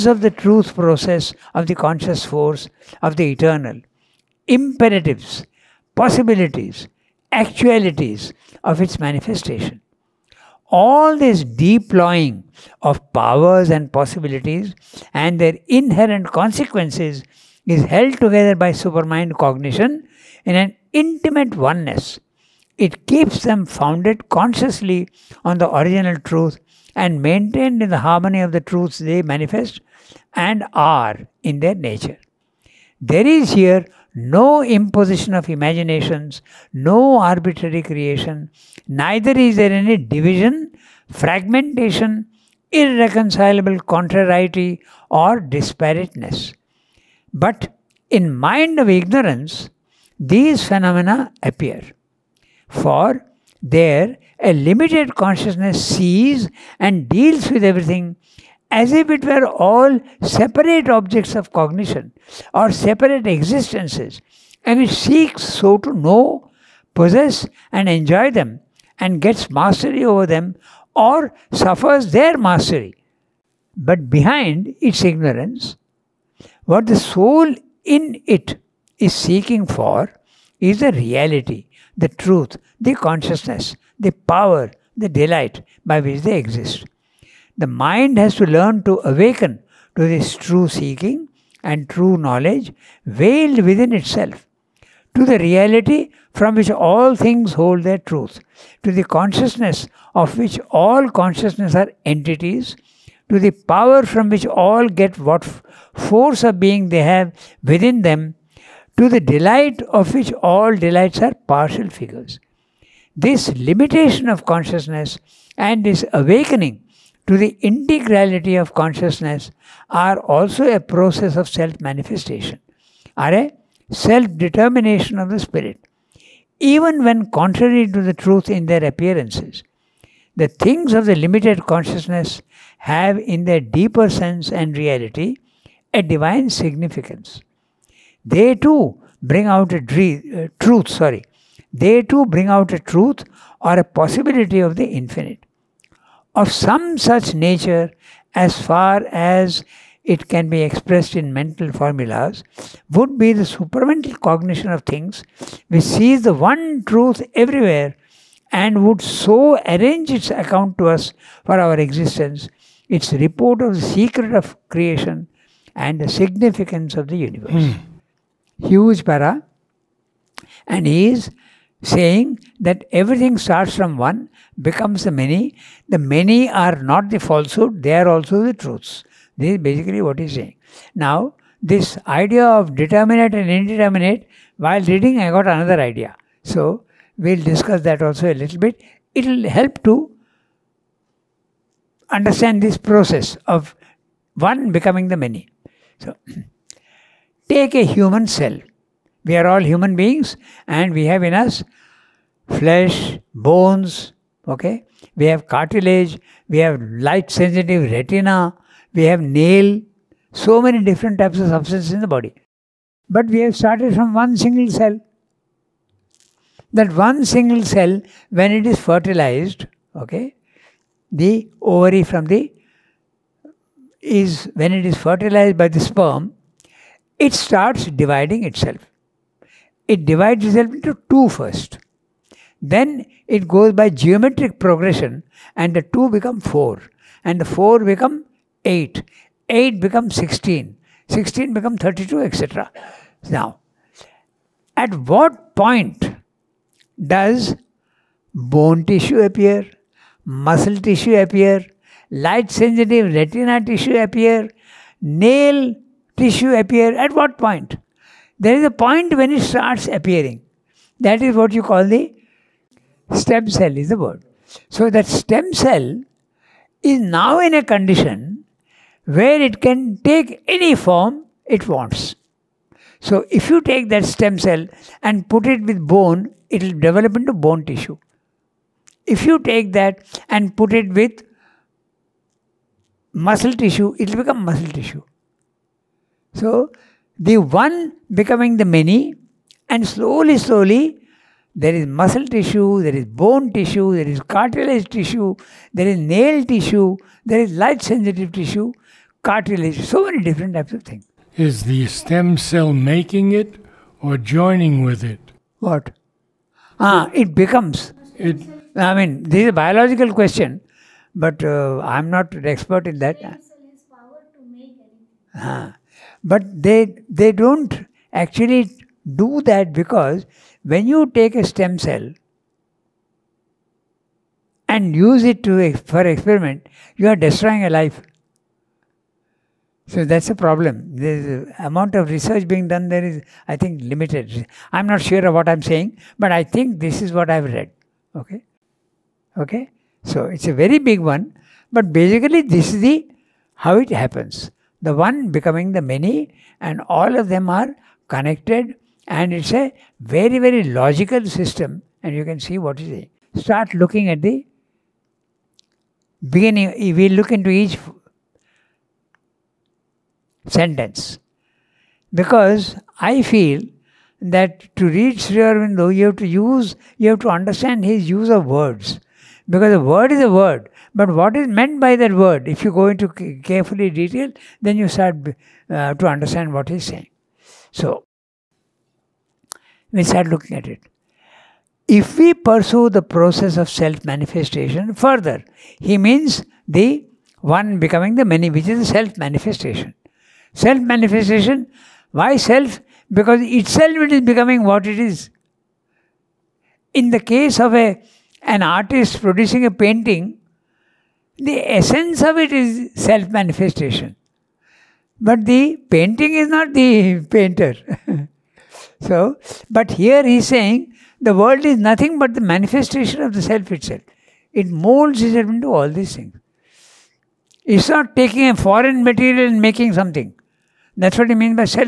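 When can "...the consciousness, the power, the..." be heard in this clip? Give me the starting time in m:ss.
1:22.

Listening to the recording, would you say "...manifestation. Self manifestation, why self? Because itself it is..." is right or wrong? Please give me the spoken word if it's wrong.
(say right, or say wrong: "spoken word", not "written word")
right.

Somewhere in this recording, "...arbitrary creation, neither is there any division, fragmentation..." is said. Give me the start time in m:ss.
0:37.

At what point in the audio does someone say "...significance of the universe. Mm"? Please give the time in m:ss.
2:46.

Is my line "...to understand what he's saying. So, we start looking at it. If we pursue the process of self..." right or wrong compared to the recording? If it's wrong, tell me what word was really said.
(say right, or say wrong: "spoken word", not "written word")
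right.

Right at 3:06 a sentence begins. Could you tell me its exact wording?
So, we'll discuss that also a little bit.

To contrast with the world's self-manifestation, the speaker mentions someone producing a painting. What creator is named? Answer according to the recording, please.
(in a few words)
An artist.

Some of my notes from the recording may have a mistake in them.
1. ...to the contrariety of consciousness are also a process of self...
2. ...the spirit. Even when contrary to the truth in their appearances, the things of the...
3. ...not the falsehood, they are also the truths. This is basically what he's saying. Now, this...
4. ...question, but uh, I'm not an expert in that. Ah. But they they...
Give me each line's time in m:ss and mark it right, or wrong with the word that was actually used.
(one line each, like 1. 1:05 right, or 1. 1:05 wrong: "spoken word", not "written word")
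1. 1:57 wrong: "integrality", not "contrariety"
2. 2:05 right
3. 2:56 right
4. 5:10 right.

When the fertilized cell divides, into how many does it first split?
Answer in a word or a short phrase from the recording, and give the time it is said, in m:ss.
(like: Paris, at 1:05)
2, at 3:51.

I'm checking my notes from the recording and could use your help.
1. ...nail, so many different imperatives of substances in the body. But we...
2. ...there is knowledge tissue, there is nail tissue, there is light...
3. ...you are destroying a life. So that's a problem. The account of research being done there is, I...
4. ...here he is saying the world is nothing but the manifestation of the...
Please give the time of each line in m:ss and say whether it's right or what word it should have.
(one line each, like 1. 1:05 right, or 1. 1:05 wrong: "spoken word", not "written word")
1. 3:29 wrong: "types", not "imperatives"
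2. 4:53 wrong: "cartilage", not "knowledge"
3. 5:26 wrong: "amount", not "account"
4. 6:49 right.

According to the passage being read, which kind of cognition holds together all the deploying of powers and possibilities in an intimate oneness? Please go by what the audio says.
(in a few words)
Supermind cognition.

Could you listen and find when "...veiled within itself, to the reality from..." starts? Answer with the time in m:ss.
1:33.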